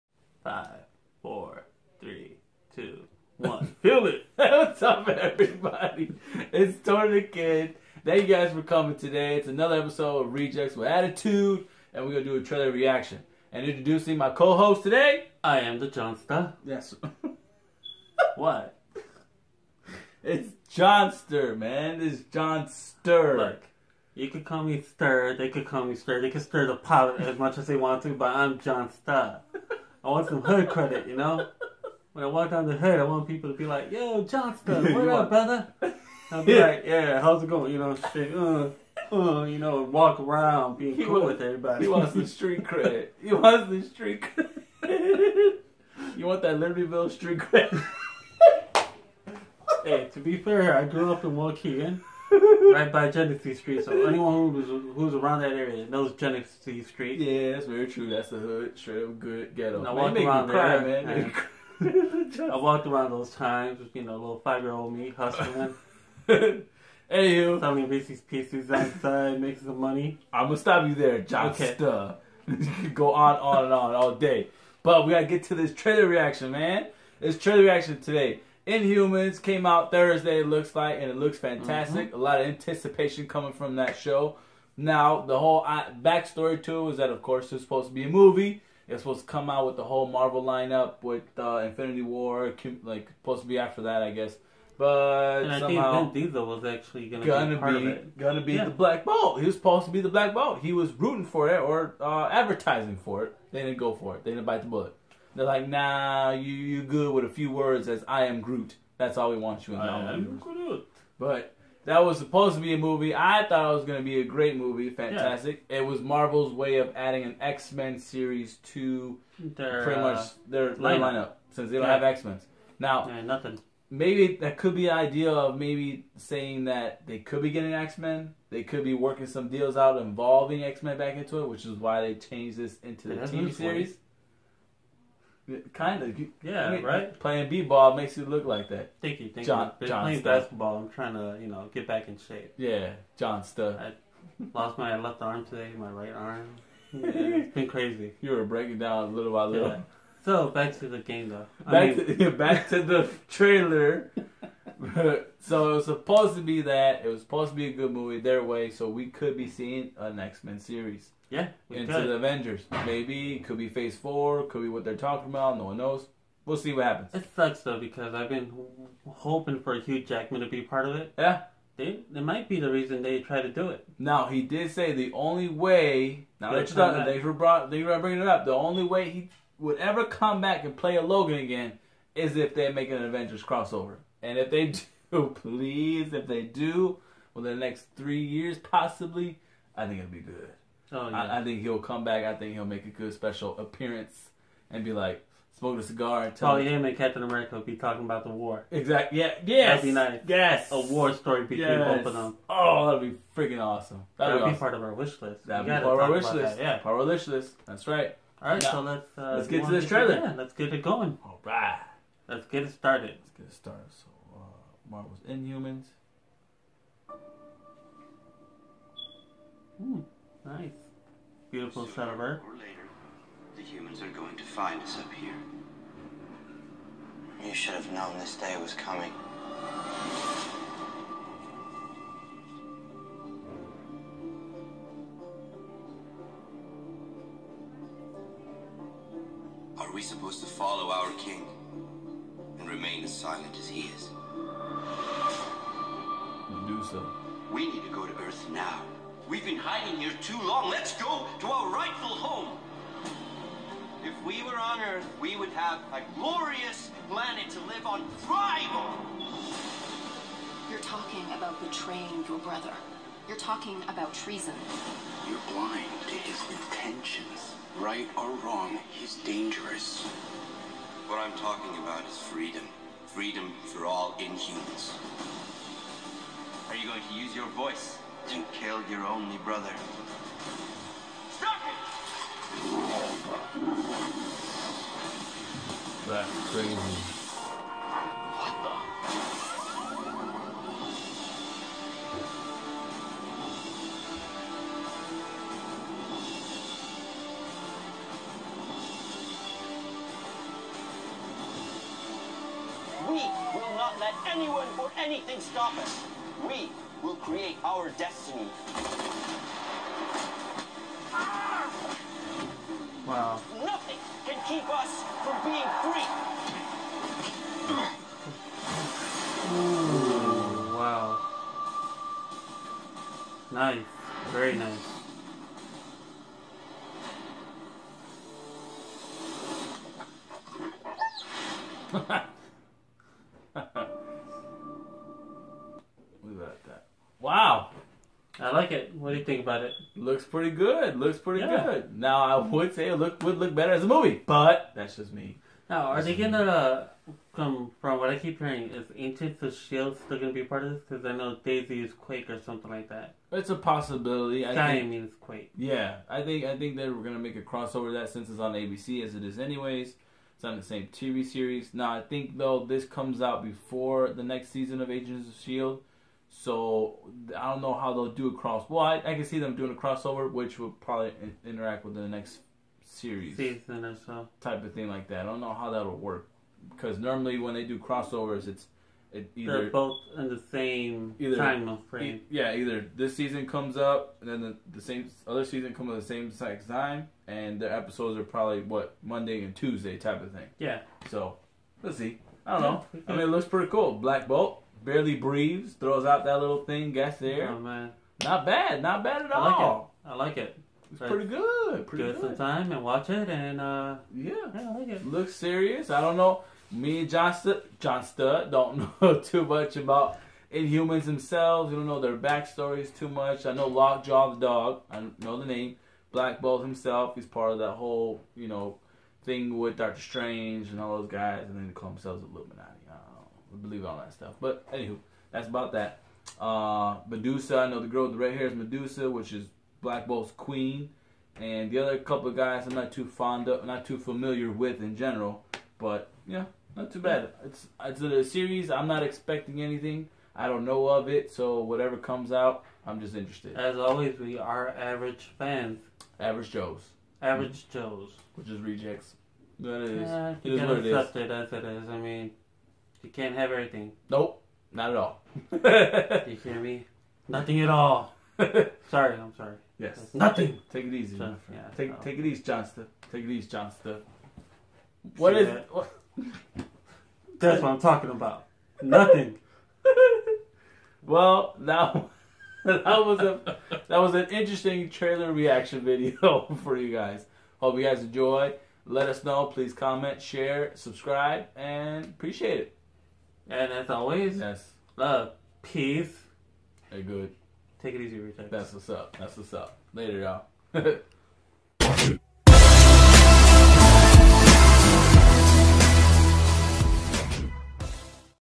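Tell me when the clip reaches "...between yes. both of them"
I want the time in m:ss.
3:21.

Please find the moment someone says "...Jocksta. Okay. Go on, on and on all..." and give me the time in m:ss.
1:11.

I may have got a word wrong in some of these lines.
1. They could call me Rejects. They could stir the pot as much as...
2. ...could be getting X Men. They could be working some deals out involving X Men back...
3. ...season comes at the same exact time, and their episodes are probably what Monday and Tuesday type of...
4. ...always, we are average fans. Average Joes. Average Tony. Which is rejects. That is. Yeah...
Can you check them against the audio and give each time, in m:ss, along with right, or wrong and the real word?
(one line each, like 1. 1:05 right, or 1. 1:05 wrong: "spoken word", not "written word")
1. 0:25 wrong: "Stir", not "Rejects"
2. 2:07 right
3. 6:25 right
4. 7:23 wrong: "Joes", not "Tony".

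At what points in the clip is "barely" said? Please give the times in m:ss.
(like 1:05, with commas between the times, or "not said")
6:34.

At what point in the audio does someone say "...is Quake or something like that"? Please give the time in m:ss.
5:51.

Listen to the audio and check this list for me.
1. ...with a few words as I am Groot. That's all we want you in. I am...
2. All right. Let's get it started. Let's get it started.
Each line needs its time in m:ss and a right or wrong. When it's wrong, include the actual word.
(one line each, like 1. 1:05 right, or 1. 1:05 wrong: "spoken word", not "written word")
1. 1:47 right
2. 3:31 right.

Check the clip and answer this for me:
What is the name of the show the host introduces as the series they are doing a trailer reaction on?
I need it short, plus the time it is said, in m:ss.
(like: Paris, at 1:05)
Rejects with Attitude, at 0:10.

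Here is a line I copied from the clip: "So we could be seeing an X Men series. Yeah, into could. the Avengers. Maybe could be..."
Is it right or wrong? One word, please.
right.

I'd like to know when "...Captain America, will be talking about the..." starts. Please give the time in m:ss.
3:16.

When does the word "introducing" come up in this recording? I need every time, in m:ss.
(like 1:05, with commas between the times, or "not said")
0:13.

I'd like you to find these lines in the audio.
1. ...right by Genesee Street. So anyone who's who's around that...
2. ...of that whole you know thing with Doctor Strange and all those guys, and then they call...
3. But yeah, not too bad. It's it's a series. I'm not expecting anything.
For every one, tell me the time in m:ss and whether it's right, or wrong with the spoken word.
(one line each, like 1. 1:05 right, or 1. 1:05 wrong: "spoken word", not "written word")
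1. 0:52 right
2. 6:57 right
3. 7:15 right.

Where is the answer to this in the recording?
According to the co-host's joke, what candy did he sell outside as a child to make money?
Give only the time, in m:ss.
1:07.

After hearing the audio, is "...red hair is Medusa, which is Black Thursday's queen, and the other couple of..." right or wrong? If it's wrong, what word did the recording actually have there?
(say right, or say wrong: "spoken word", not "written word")
wrong: "Bolt", not "Thursday".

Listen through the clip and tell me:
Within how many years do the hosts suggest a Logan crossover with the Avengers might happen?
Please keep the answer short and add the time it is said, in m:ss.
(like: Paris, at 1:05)
3, at 3:07.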